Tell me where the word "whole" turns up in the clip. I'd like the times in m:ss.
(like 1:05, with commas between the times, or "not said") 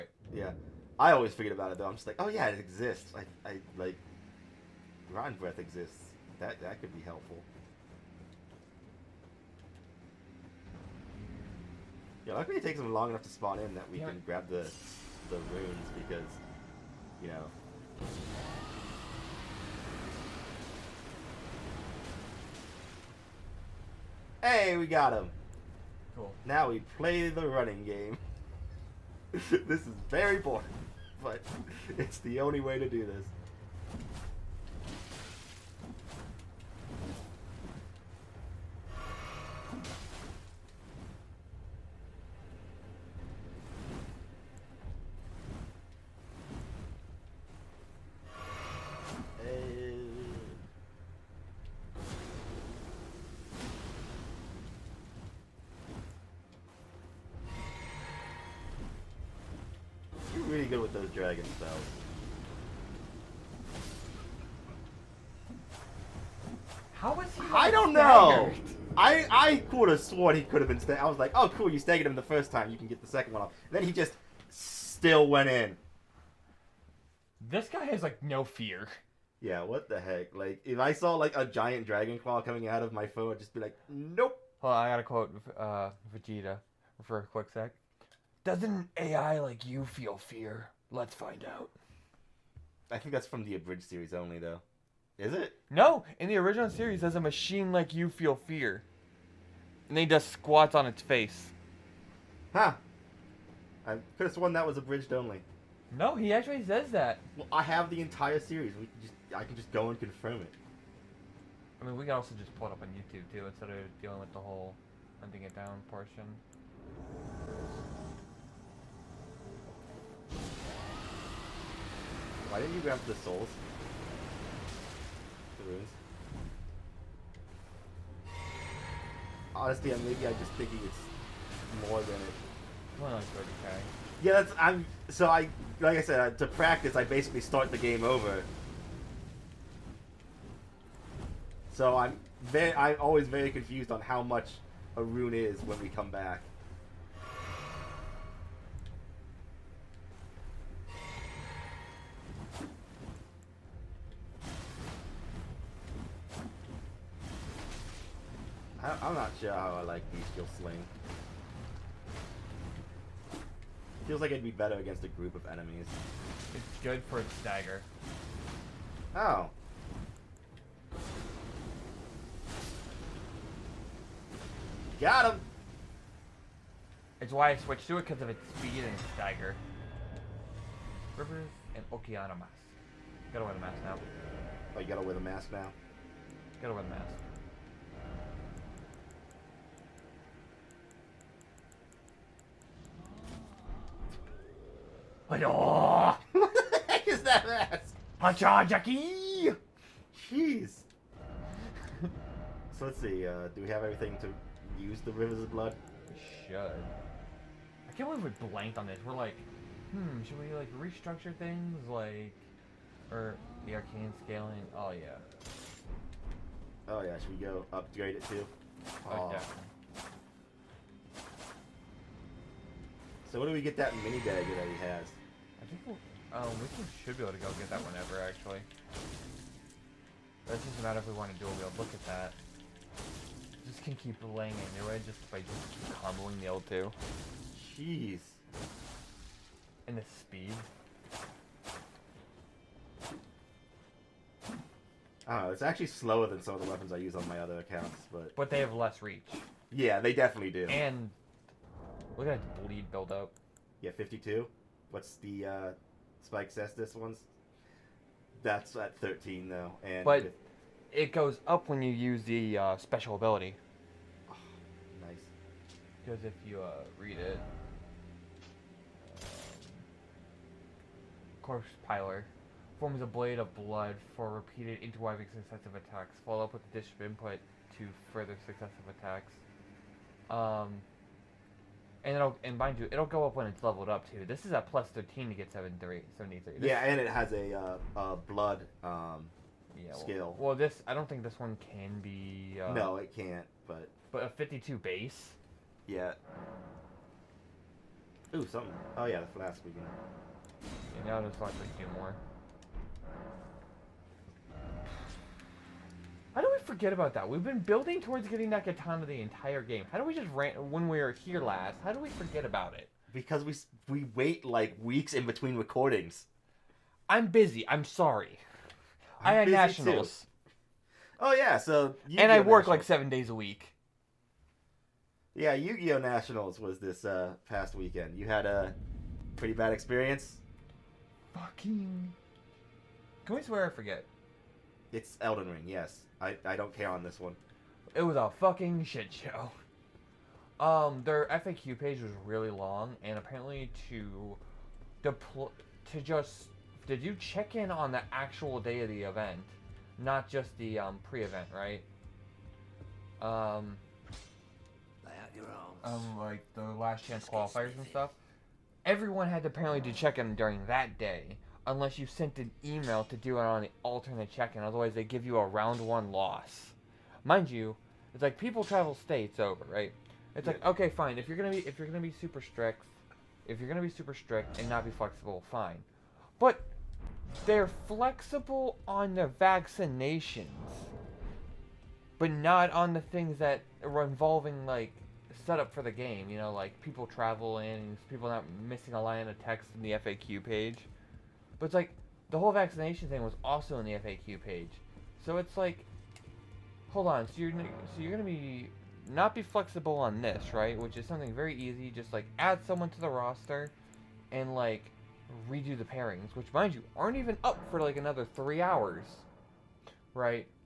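1:54, 6:32.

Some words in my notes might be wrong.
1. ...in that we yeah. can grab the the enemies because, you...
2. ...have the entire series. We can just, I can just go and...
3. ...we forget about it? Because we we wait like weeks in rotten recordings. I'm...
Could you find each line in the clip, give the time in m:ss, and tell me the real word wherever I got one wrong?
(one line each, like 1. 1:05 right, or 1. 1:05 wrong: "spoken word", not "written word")
1. 0:13 wrong: "runes", not "enemies"
2. 1:47 right
3. 5:11 wrong: "between", not "rotten".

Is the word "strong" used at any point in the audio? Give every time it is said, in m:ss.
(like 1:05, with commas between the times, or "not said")
not said.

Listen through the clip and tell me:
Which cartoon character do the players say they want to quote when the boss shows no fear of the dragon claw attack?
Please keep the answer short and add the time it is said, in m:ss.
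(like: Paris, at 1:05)
Vegeta, at 1:26.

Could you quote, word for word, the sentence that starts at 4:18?
That's at 13 though, and But- It goes up when you use the uh, special ability.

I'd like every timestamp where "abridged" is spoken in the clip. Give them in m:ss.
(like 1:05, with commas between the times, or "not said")
1:33, 1:44.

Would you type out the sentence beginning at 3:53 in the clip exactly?
Just can keep laying into it just by just comboing the L2.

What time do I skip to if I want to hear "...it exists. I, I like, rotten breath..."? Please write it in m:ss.
0:02.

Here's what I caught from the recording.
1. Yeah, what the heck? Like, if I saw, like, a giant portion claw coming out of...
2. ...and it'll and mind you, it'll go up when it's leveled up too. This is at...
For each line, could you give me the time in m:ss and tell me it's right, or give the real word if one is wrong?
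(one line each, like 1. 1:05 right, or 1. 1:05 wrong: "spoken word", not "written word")
1. 1:19 wrong: "dragon", not "portion"
2. 4:42 right.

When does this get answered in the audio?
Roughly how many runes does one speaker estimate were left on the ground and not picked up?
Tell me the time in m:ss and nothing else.
2:13.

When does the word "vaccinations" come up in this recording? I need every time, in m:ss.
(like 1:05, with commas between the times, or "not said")
6:19, 6:32.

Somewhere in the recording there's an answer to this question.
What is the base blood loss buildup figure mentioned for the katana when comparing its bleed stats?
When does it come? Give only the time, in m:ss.
4:13.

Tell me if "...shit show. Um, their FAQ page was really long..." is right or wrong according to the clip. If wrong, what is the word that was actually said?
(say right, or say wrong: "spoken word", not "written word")
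right.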